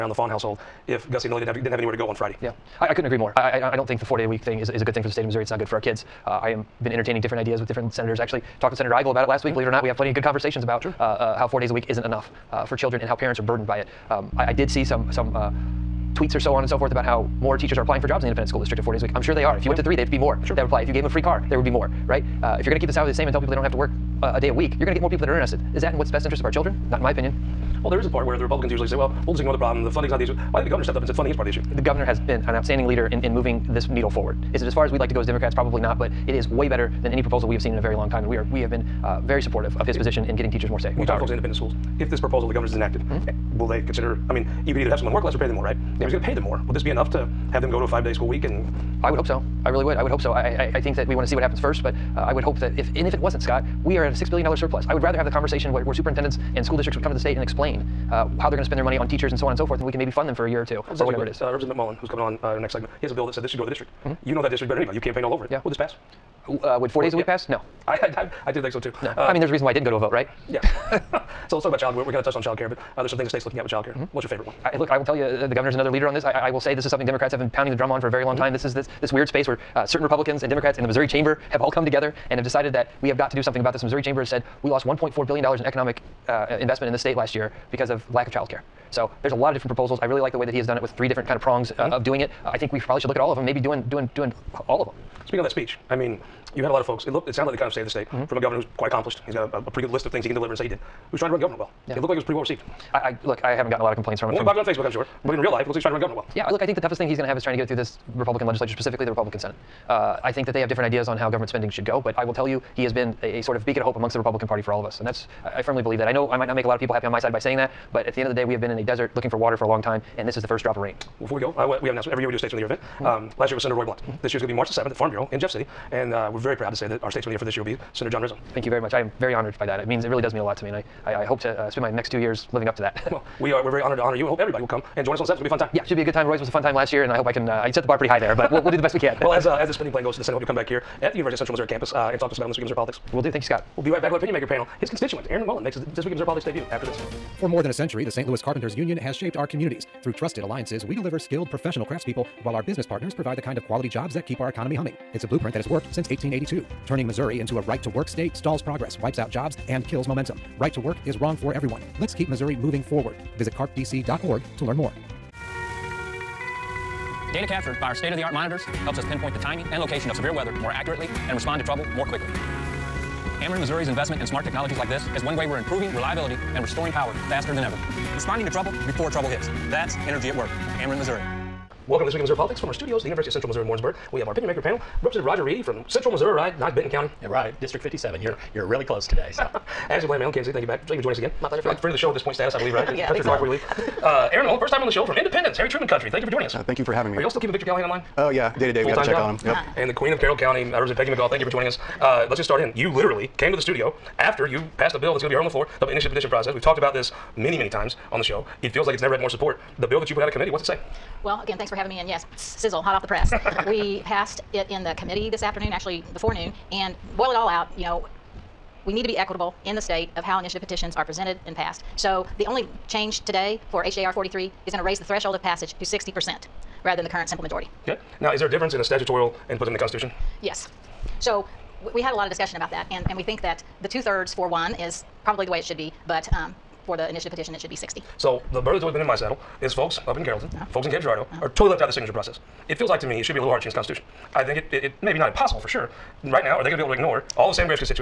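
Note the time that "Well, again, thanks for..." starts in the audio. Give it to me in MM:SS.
03:31.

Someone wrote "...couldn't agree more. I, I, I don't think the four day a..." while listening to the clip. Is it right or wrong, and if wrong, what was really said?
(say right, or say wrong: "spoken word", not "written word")
right.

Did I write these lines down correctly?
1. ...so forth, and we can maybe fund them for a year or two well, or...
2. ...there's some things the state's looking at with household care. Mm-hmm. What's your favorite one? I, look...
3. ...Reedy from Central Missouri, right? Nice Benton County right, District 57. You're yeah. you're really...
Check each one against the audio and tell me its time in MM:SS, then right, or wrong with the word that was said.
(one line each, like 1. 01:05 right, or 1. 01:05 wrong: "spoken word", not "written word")
1. 00:59 right
2. 01:13 wrong: "child", not "household"
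3. 03:05 right.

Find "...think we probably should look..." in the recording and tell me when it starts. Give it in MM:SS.
01:32.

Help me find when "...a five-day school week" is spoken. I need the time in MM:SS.
00:47.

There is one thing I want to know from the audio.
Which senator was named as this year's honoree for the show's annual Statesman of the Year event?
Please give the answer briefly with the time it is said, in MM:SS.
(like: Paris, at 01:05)
John Rizzo, at 02:08.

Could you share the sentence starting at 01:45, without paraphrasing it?
But in real life, it looks like he's trying to run government well.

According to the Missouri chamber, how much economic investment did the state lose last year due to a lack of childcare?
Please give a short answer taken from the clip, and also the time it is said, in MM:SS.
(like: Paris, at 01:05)
$1.4 billion, at 01:24.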